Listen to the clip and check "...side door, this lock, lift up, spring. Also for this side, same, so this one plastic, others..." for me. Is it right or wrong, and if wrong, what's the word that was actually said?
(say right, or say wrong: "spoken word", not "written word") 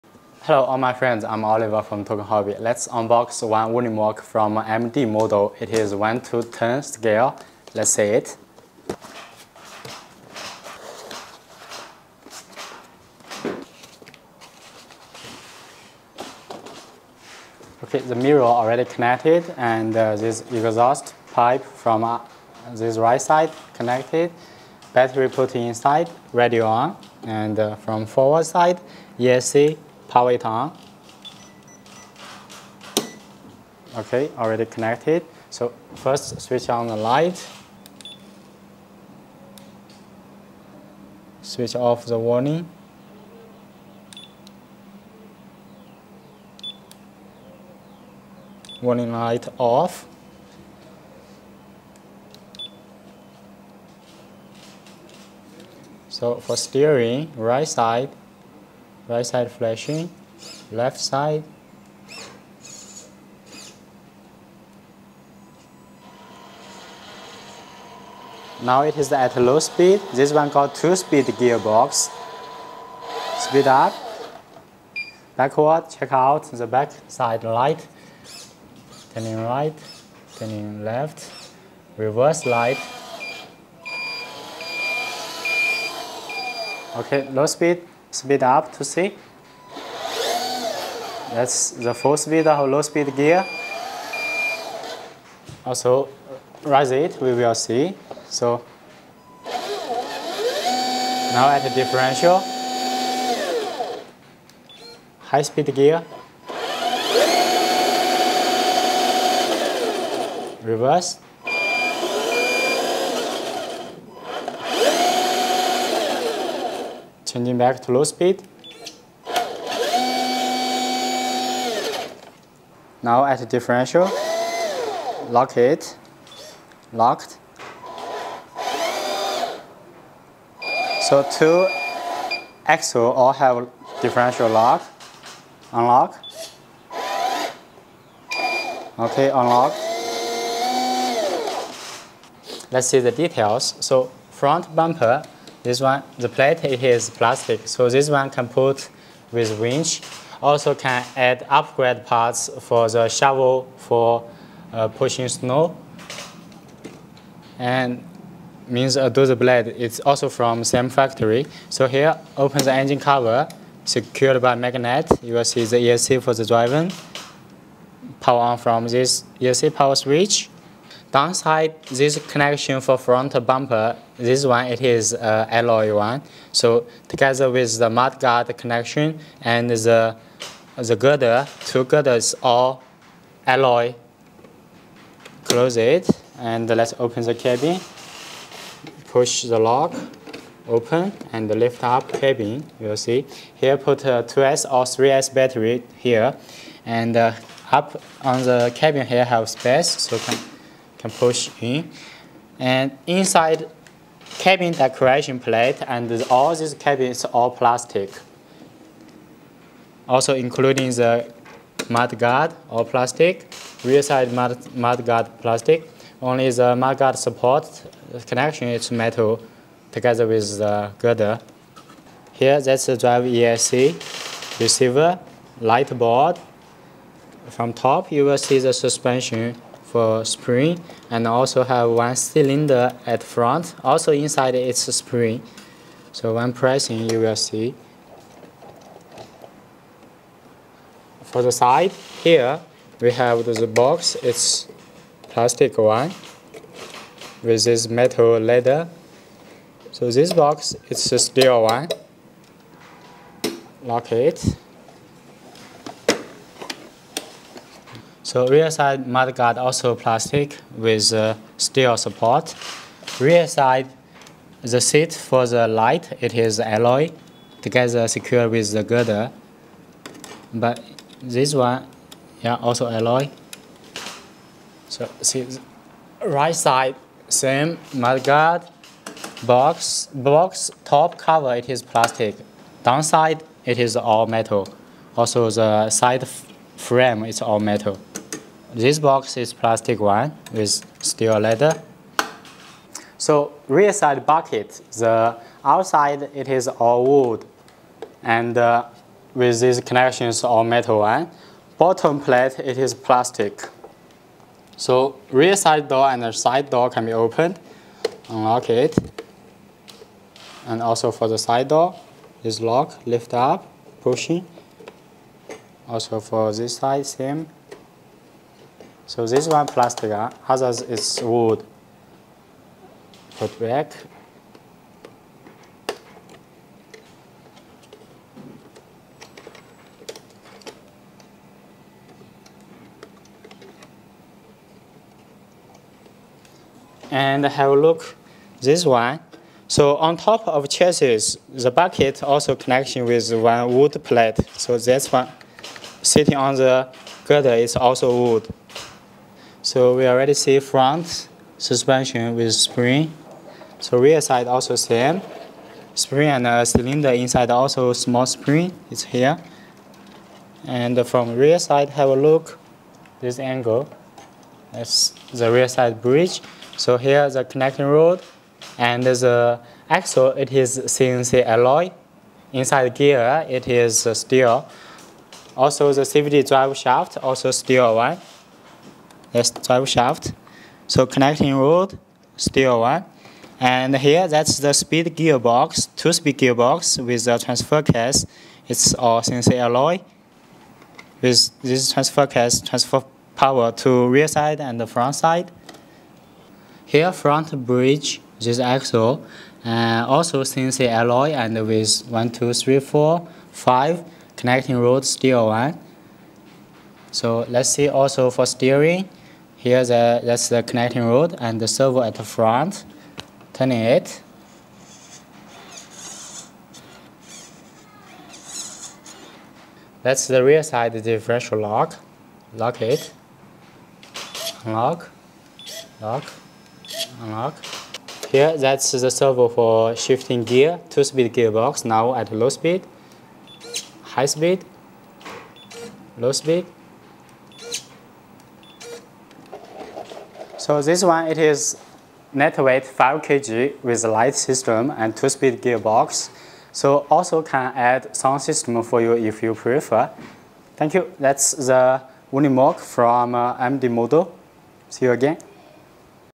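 wrong: "pushing", not "spring".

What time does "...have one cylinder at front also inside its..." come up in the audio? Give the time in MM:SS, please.
03:51.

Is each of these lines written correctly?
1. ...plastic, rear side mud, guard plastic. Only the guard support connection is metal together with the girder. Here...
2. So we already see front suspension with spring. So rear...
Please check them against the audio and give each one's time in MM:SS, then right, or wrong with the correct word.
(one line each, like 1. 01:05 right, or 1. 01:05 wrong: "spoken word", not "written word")
1. 03:32 right
2. 05:49 right.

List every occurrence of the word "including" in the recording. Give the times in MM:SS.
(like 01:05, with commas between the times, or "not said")
03:30.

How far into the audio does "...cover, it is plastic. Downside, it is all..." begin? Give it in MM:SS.
04:41.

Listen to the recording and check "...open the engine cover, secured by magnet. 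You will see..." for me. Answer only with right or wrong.
right.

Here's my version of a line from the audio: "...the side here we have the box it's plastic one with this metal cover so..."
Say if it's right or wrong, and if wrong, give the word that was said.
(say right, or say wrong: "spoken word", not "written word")
wrong: "leather", not "cover".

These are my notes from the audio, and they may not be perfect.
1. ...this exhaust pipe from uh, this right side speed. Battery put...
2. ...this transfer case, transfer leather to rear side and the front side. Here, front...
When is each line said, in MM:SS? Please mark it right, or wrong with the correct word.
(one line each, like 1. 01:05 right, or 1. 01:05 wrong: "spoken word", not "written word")
1. 00:20 wrong: "connected", not "speed"
2. 06:31 wrong: "power", not "leather".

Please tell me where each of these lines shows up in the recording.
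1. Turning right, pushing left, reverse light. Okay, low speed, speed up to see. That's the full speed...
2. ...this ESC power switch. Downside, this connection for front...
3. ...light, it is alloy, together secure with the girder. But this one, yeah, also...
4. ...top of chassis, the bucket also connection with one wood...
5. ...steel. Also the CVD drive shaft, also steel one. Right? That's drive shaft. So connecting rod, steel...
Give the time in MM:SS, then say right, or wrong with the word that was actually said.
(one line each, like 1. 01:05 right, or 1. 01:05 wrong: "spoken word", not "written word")
1. 01:19 wrong: "turning", not "pushing"
2. 02:48 right
3. 04:25 right
4. 05:40 right
5. 06:14 right.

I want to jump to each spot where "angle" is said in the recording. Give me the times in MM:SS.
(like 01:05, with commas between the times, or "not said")
06:03.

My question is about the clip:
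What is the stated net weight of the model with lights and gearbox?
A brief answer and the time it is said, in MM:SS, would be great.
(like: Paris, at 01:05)
5 kg, at 07:22.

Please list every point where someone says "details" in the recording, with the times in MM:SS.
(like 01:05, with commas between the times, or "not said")
02:23.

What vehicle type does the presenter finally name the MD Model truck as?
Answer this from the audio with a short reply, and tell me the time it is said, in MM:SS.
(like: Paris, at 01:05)
Unimog, at 07:32.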